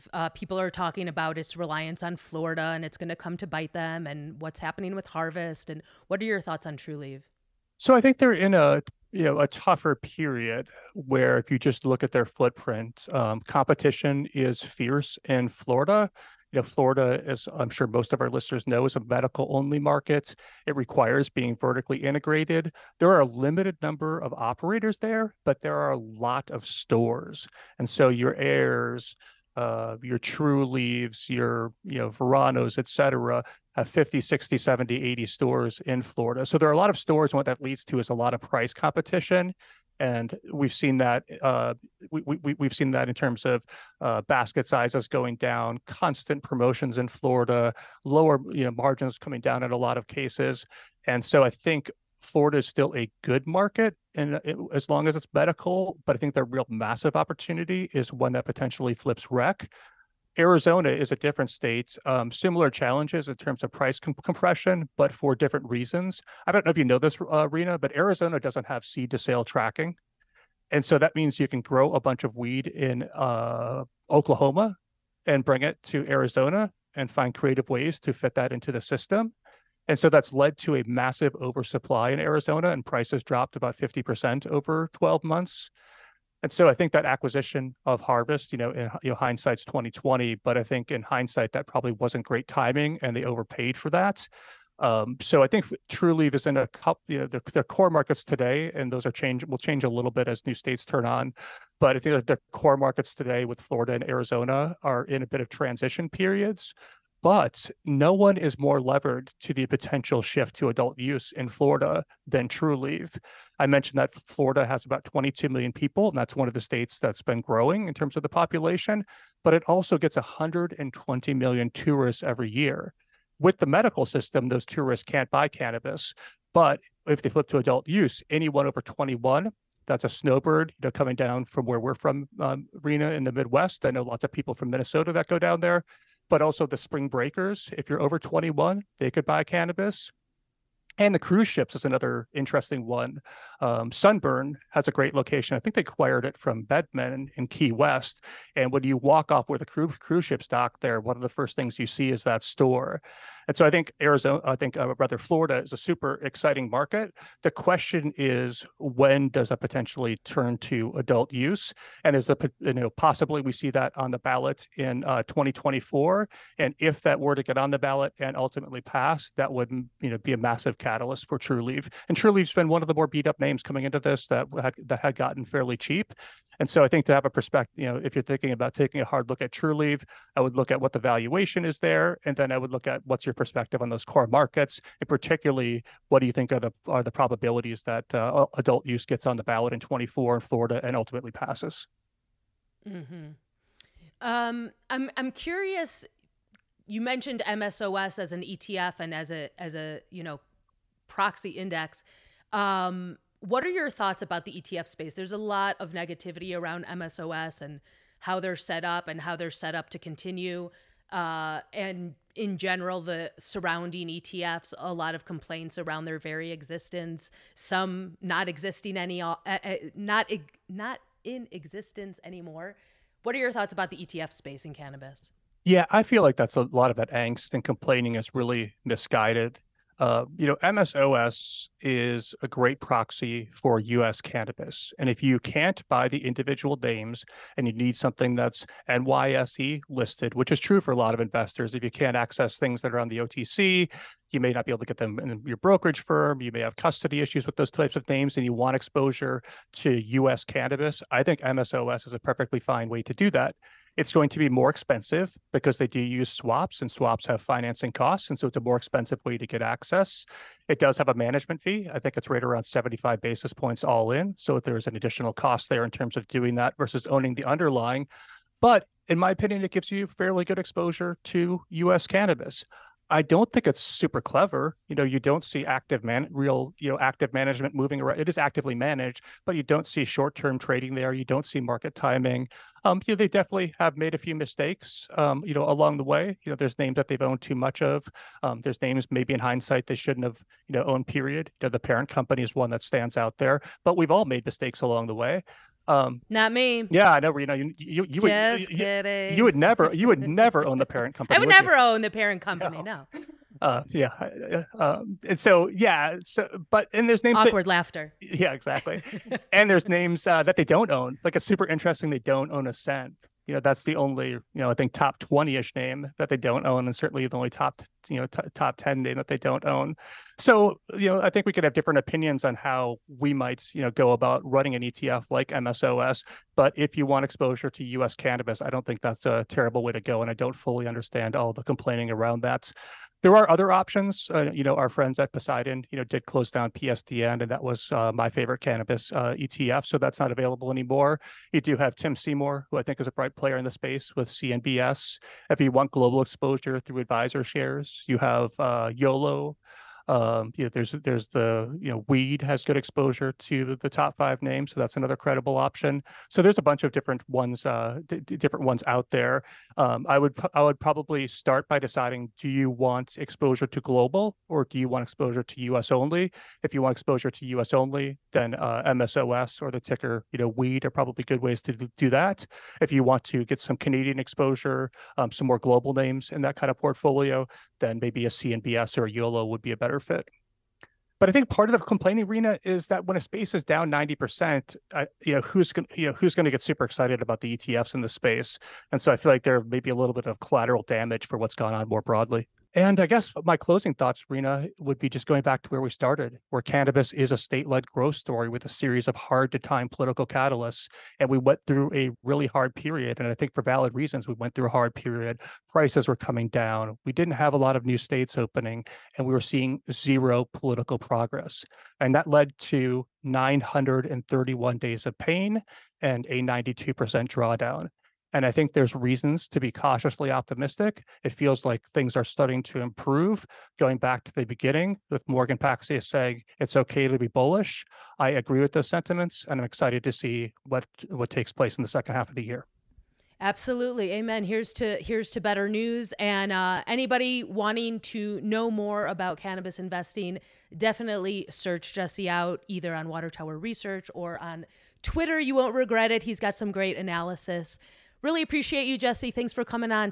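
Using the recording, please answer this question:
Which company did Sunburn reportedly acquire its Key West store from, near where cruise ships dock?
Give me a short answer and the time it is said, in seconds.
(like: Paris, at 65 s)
Bedman, at 146 s.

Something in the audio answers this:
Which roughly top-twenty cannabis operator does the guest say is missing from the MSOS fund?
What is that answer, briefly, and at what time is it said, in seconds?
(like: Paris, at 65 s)
Ascend, at 312 s.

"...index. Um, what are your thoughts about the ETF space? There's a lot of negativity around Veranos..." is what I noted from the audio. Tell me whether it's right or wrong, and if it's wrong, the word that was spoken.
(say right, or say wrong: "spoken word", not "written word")
wrong: "MSOS", not "Veranos".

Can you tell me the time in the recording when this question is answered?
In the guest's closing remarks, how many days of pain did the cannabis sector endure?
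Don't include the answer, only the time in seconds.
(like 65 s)
413 s.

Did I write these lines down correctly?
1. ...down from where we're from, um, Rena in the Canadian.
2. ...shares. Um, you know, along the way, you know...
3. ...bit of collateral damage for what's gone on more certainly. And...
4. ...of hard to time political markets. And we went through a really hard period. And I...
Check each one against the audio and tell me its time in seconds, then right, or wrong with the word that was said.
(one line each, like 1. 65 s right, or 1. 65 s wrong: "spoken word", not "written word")
1. 131 s wrong: "Midwest", not "Canadian"
2. 284 s wrong: "mistakes", not "shares"
3. 390 s wrong: "broadly", not "certainly"
4. 399 s wrong: "catalysts", not "markets".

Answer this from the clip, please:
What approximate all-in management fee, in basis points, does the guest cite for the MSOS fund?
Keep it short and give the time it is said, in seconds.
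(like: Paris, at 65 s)
75 basis points, at 262 s.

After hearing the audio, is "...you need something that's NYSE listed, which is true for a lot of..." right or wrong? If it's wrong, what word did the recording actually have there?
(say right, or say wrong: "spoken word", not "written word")
right.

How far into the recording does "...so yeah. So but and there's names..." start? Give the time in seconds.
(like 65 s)
305 s.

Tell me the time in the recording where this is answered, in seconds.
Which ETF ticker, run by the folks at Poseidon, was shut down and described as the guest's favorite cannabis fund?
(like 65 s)
336 s.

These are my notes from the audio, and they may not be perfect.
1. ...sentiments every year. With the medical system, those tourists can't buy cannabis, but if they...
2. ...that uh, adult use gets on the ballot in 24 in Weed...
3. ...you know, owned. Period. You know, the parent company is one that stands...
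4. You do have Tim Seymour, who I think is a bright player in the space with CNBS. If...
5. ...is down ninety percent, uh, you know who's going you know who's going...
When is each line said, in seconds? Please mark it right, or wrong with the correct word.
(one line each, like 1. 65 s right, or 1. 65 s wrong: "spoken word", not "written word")
1. 121 s wrong: "tourists", not "sentiments"
2. 187 s wrong: "Florida", not "Weed"
3. 290 s right
4. 341 s right
5. 383 s right.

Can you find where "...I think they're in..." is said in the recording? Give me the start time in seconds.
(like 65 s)
7 s.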